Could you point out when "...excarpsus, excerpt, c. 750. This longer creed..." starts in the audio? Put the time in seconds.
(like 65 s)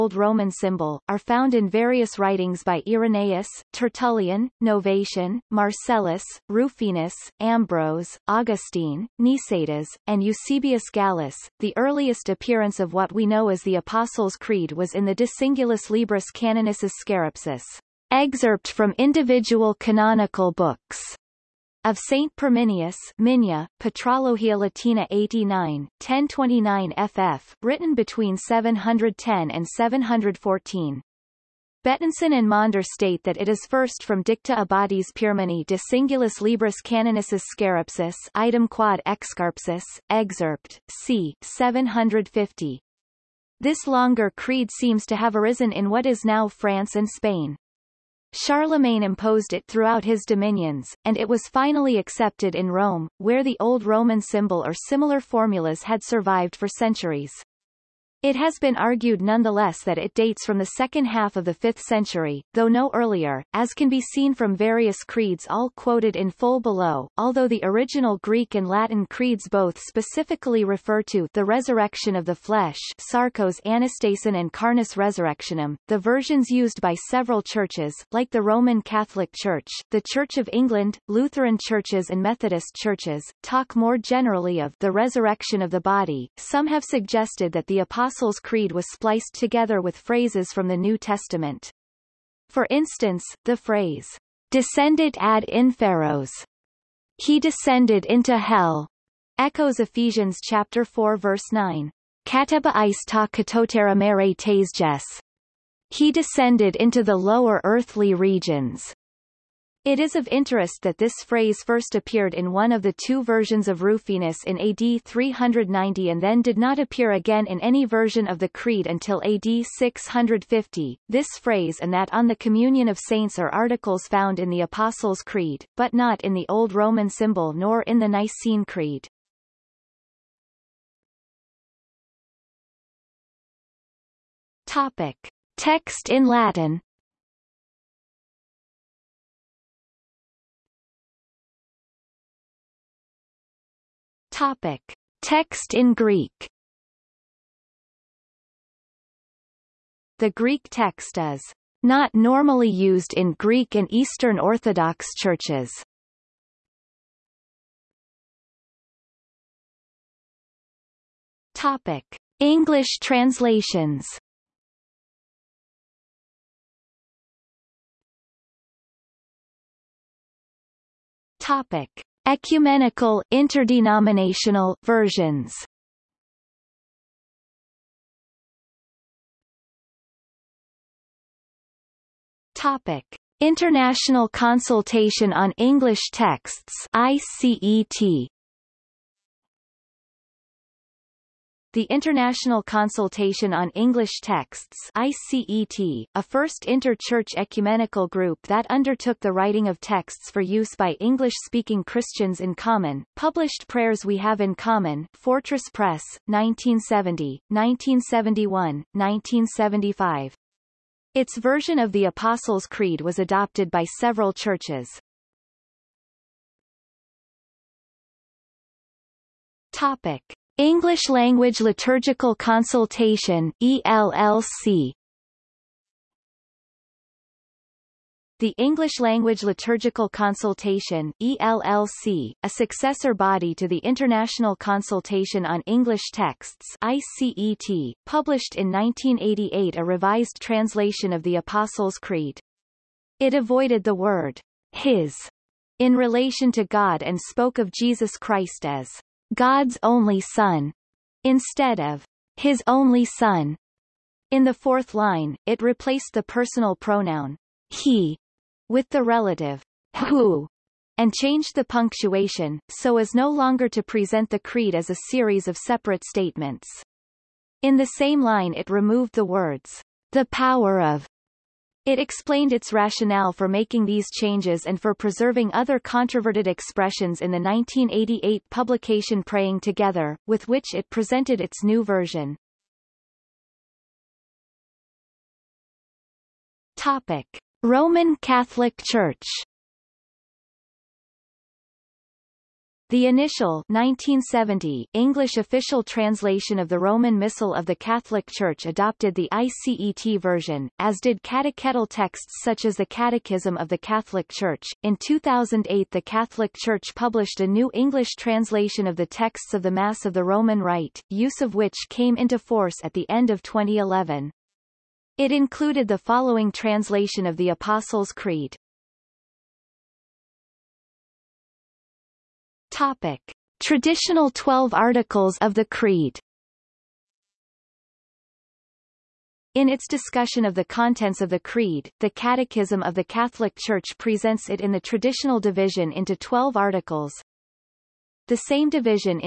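39 s.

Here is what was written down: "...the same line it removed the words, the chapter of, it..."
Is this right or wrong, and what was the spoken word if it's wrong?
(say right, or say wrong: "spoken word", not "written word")
wrong: "power", not "chapter".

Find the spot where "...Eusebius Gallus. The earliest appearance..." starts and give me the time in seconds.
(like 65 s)
10 s.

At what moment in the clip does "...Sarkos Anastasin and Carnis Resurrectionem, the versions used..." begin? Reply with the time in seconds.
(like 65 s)
72 s.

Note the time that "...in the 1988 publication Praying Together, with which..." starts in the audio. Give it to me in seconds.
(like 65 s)
277 s.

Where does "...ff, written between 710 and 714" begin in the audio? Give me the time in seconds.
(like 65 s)
27 s.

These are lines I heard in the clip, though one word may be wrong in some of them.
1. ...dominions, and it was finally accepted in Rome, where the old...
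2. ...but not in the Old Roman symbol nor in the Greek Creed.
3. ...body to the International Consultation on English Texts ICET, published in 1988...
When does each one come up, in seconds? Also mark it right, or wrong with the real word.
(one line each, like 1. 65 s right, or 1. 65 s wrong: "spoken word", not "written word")
1. 50 s right
2. 125 s wrong: "Nicene", not "Greek"
3. 233 s right.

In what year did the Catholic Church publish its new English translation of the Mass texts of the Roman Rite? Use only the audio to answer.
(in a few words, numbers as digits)
2008.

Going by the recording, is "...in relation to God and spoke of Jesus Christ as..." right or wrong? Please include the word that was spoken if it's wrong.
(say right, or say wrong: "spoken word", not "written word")
right.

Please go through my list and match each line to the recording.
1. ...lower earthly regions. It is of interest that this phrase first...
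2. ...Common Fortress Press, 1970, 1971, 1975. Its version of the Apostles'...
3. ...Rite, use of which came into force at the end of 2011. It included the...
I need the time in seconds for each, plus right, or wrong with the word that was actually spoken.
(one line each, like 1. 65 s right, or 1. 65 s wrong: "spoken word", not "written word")
1. 107 s right
2. 204 s right
3. 310 s right.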